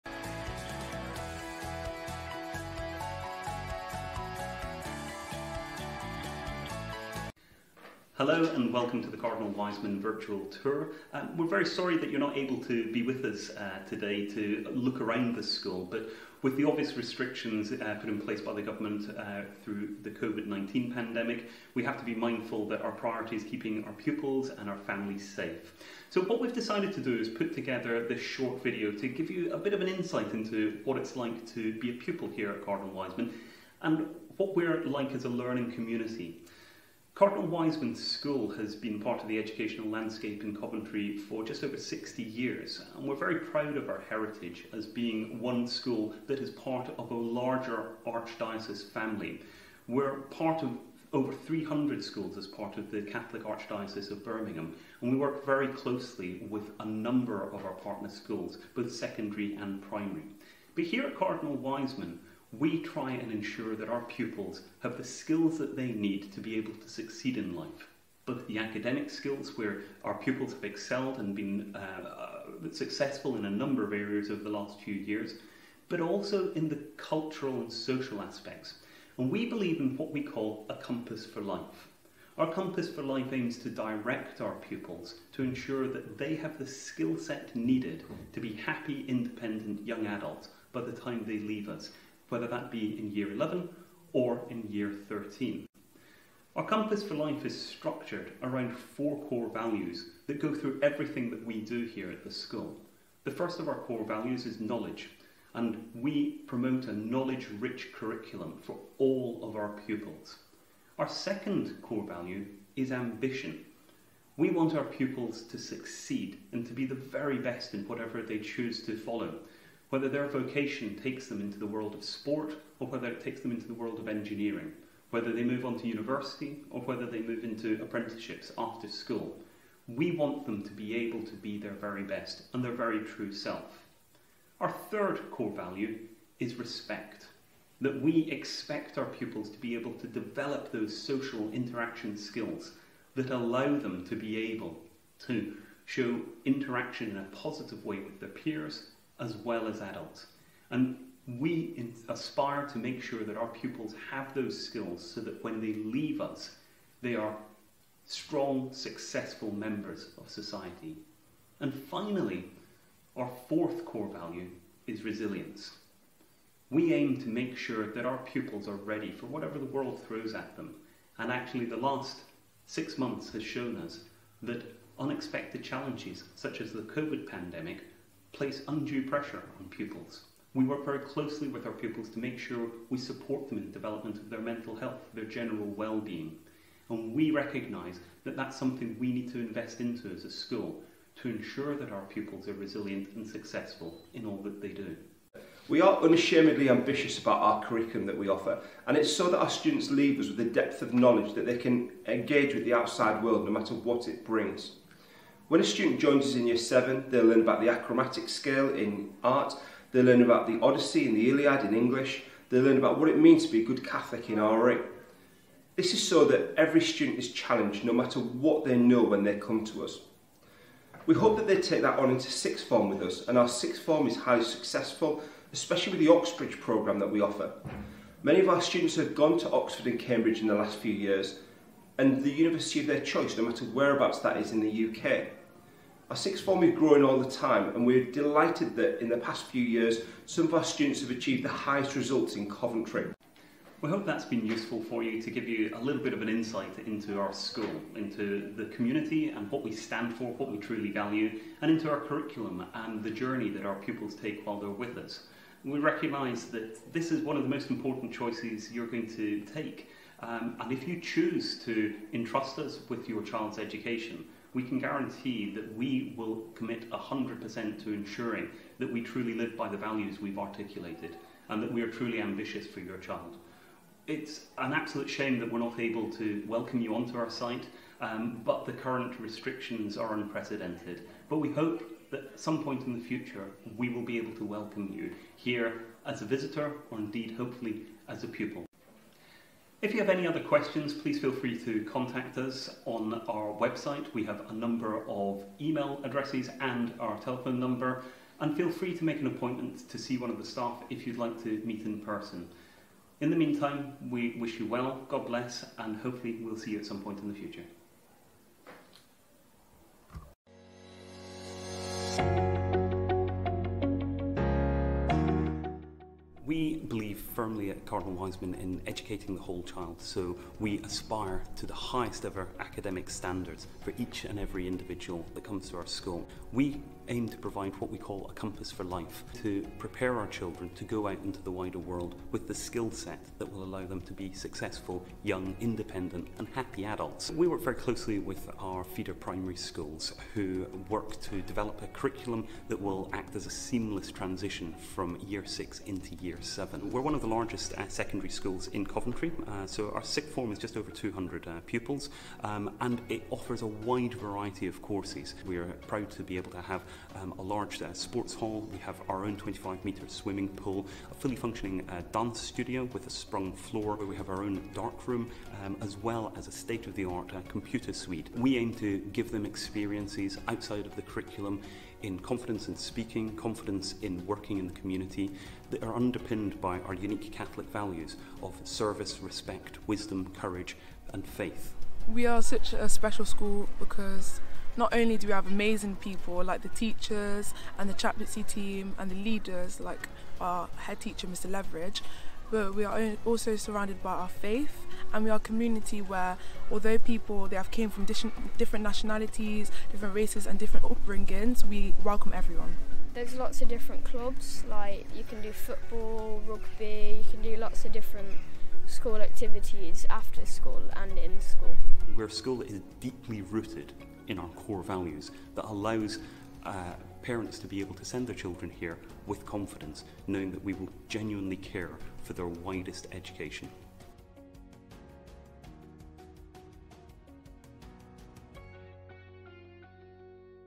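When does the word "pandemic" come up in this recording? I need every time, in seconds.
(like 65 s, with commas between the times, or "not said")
20 s, 177 s.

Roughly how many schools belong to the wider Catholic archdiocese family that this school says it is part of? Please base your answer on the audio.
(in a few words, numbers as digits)
over 300.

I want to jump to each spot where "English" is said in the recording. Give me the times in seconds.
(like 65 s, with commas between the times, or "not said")
211 s.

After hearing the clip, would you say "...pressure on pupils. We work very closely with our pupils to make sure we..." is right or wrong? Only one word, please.
right.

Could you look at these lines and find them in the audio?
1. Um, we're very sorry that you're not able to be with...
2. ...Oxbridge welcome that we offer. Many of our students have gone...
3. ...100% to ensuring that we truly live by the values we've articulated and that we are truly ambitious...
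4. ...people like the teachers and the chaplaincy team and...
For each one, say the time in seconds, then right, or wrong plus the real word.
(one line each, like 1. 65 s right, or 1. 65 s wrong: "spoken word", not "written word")
1. 11 s right
2. 226 s wrong: "programme", not "welcome"
3. 266 s right
4. 385 s right.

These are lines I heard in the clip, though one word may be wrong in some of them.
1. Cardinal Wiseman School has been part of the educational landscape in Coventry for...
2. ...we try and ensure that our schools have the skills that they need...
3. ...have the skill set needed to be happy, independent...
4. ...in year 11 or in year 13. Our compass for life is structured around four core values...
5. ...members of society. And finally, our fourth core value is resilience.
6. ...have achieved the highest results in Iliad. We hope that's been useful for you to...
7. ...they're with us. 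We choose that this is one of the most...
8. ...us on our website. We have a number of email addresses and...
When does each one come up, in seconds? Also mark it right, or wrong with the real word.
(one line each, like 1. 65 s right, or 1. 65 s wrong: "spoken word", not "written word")
1. 37 s right
2. 62 s wrong: "pupils", not "schools"
3. 86 s right
4. 92 s right
5. 159 s right
6. 240 s wrong: "Coventry", not "Iliad"
7. 254 s wrong: "recognise", not "choose"
8. 292 s right.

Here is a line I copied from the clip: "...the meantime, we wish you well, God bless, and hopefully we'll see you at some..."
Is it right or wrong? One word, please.
right.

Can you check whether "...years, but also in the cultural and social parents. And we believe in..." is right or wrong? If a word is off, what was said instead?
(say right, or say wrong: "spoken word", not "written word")
wrong: "aspects", not "parents".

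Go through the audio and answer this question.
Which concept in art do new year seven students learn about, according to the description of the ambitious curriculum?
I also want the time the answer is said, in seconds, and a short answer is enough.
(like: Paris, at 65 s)
achromatic scale, at 207 s.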